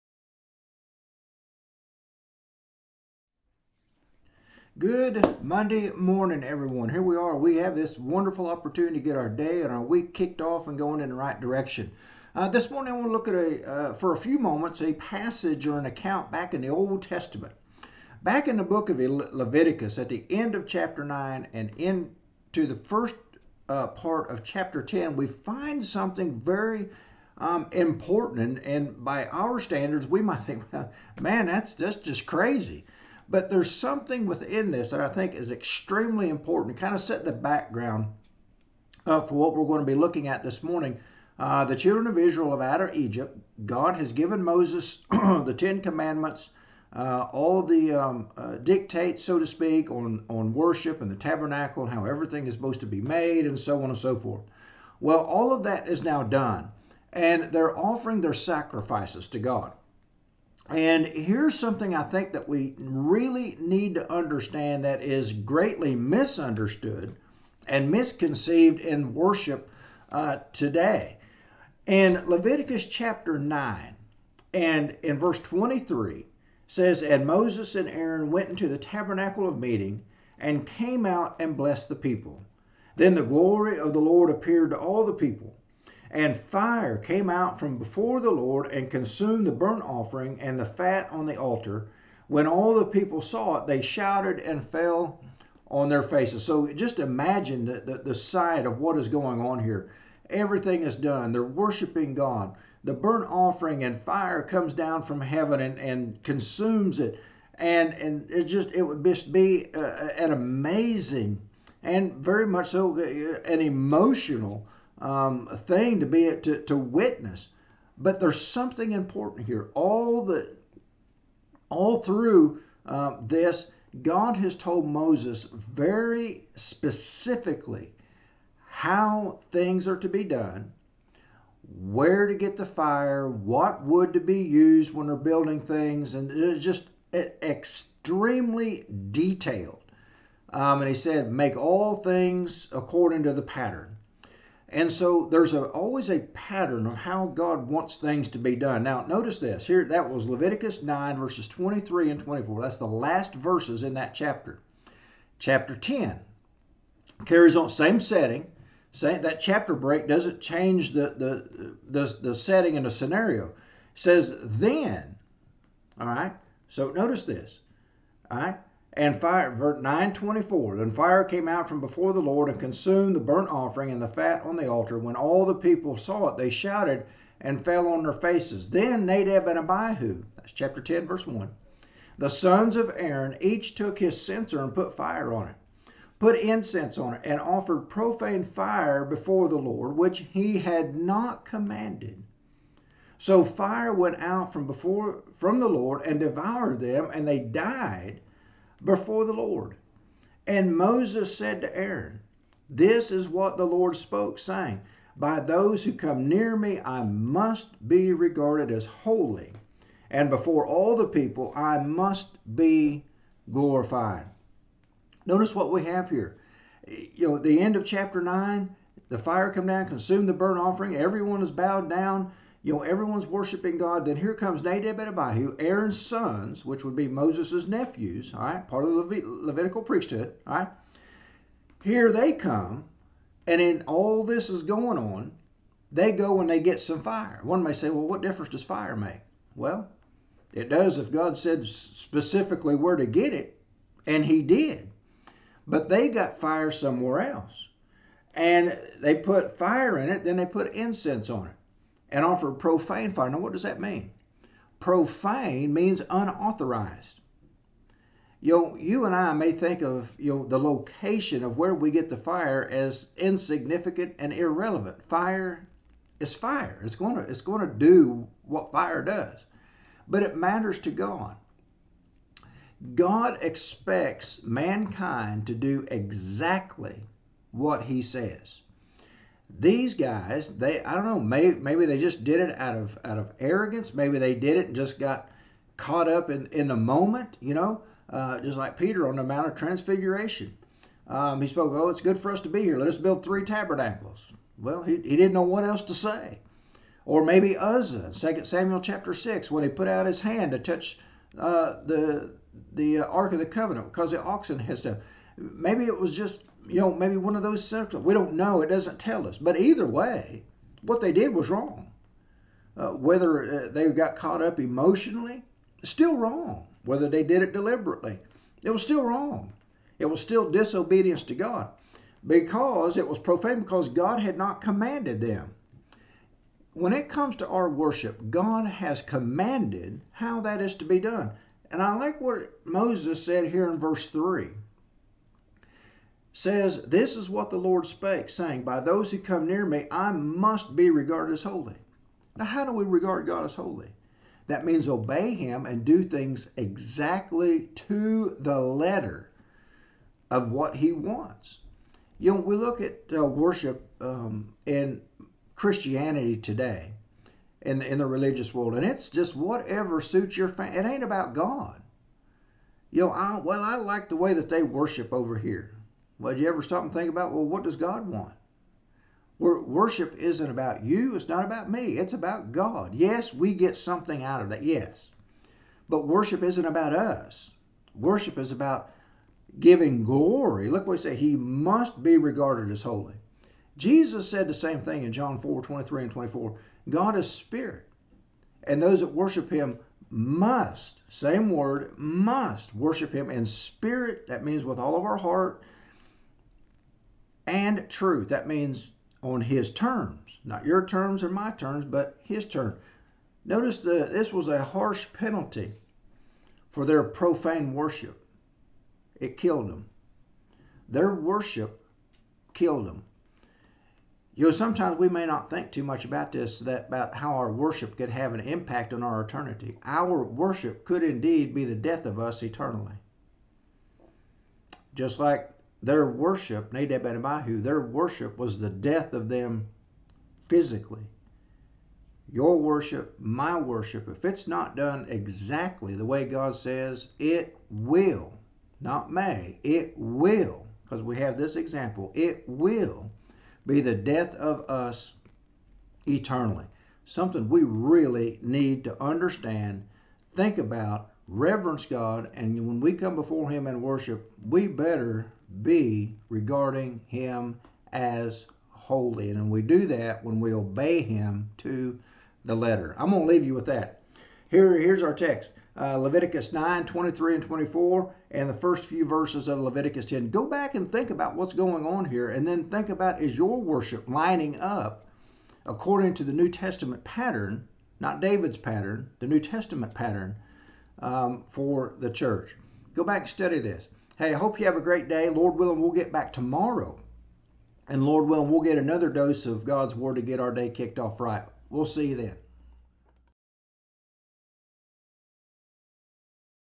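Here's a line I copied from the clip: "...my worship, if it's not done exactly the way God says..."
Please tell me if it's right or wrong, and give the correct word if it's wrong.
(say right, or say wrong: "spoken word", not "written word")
right.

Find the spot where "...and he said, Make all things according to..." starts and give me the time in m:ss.
2:20.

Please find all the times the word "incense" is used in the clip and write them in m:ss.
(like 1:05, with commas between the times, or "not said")
3:06, 4:10.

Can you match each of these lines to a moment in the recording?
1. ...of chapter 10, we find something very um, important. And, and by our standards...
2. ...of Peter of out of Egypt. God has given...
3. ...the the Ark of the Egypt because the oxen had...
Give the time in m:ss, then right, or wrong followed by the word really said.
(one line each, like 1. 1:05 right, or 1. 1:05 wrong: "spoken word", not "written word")
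1. 0:24 right
2. 0:42 wrong: "Israel", not "Peter"
3. 5:01 wrong: "Covenant", not "Egypt".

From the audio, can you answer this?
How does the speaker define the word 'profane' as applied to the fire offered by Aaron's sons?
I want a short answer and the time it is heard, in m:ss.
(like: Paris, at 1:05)
Unauthorized, at 4:14.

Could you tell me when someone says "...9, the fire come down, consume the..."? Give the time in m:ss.
3:38.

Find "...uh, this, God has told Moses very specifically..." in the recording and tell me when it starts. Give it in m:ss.
2:02.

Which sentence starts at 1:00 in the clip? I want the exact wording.
And here's something I think that we really need to understand that is greatly misunderstood and misconceived in worship uh, today.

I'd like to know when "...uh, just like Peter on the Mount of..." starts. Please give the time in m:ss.
4:48.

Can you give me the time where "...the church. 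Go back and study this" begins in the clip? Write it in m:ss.
8:01.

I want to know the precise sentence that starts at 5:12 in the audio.
Uh, whether uh, they got caught up emotionally, still wrong.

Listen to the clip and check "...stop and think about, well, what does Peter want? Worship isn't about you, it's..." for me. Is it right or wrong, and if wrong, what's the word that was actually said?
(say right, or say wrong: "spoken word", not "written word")
wrong: "God", not "Peter".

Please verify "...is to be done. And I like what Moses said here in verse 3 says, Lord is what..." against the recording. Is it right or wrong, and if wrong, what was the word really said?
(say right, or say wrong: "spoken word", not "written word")
wrong: "This", not "Lord".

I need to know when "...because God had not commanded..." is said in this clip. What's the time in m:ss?
5:23.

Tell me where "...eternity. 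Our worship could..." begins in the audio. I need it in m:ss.
6:59.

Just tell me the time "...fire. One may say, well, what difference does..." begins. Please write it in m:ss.
3:57.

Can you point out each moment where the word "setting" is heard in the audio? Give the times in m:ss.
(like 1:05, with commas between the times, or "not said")
2:37, 2:42.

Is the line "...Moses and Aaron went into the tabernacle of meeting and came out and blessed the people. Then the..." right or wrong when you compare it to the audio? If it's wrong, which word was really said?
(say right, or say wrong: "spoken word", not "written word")
right.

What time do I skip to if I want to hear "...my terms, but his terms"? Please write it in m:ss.
6:41.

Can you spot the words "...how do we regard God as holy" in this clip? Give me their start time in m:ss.
5:42.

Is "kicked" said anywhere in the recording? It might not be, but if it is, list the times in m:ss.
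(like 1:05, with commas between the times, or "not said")
0:10, 8:10.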